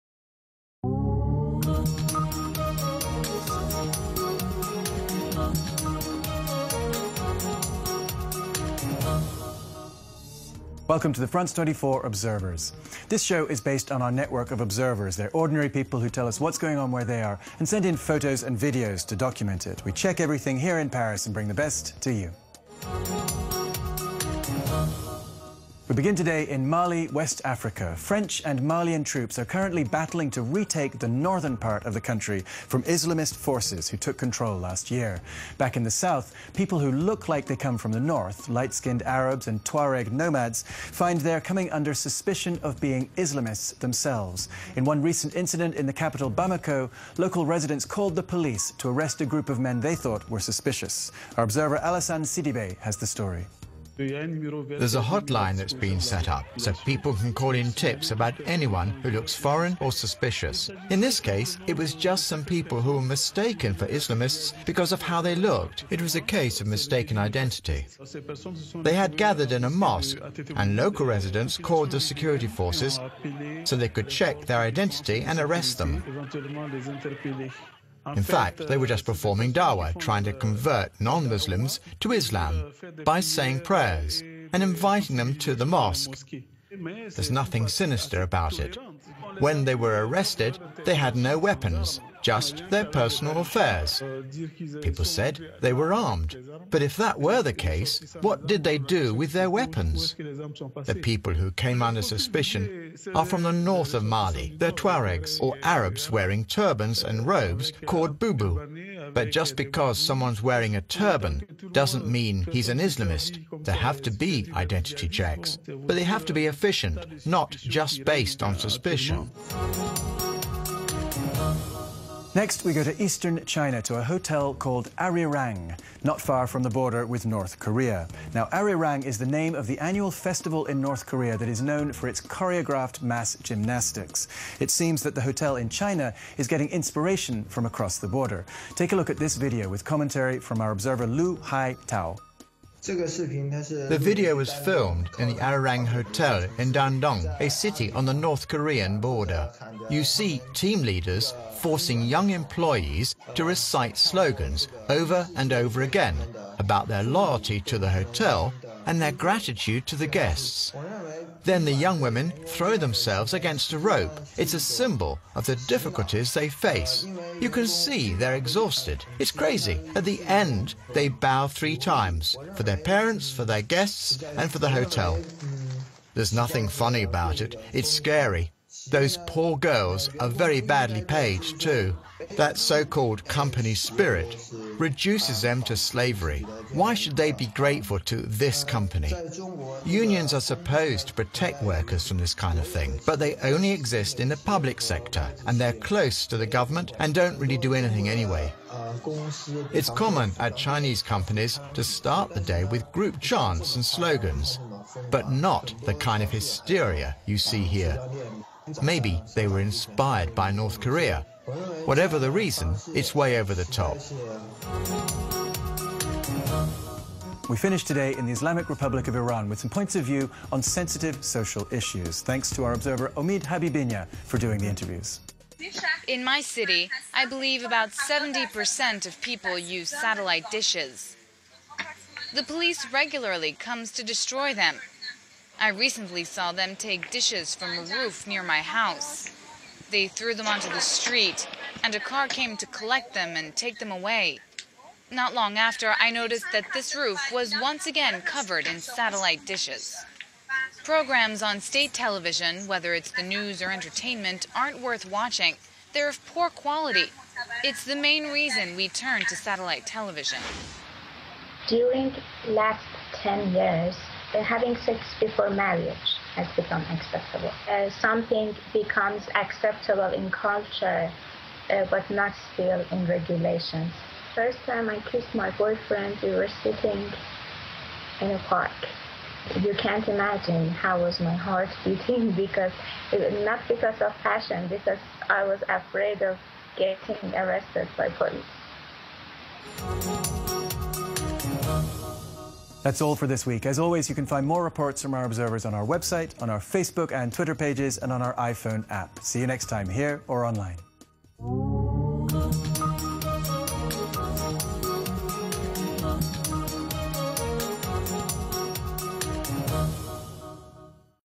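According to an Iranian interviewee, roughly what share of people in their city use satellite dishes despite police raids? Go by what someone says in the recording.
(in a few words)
70%.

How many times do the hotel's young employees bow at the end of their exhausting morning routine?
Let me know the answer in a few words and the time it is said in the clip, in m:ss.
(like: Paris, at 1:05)
3, at 2:51.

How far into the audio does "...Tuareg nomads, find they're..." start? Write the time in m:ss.
0:39.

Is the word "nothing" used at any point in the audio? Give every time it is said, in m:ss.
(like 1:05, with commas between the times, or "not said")
1:27, 2:56.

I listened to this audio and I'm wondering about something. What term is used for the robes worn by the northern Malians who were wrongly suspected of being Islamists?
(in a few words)
bubu.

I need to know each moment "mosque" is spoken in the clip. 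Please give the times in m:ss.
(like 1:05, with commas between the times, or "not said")
1:09, 1:25.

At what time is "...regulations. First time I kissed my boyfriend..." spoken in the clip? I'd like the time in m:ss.
4:33.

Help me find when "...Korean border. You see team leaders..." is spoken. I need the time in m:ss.
2:28.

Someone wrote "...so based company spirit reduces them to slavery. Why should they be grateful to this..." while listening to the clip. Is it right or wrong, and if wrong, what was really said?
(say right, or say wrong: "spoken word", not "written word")
wrong: "called", not "based".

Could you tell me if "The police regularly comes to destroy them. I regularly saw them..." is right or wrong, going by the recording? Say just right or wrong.
wrong.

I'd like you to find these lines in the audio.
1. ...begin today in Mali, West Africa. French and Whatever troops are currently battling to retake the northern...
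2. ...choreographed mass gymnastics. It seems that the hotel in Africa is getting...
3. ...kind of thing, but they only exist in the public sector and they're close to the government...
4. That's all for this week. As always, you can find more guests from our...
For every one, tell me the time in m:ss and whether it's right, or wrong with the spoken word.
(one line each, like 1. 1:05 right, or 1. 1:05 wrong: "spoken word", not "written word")
1. 0:25 wrong: "Malian", not "Whatever"
2. 2:12 wrong: "China", not "Africa"
3. 3:12 right
4. 4:52 wrong: "reports", not "guests".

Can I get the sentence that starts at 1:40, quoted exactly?
The people who came under suspicion are from the north of Mali.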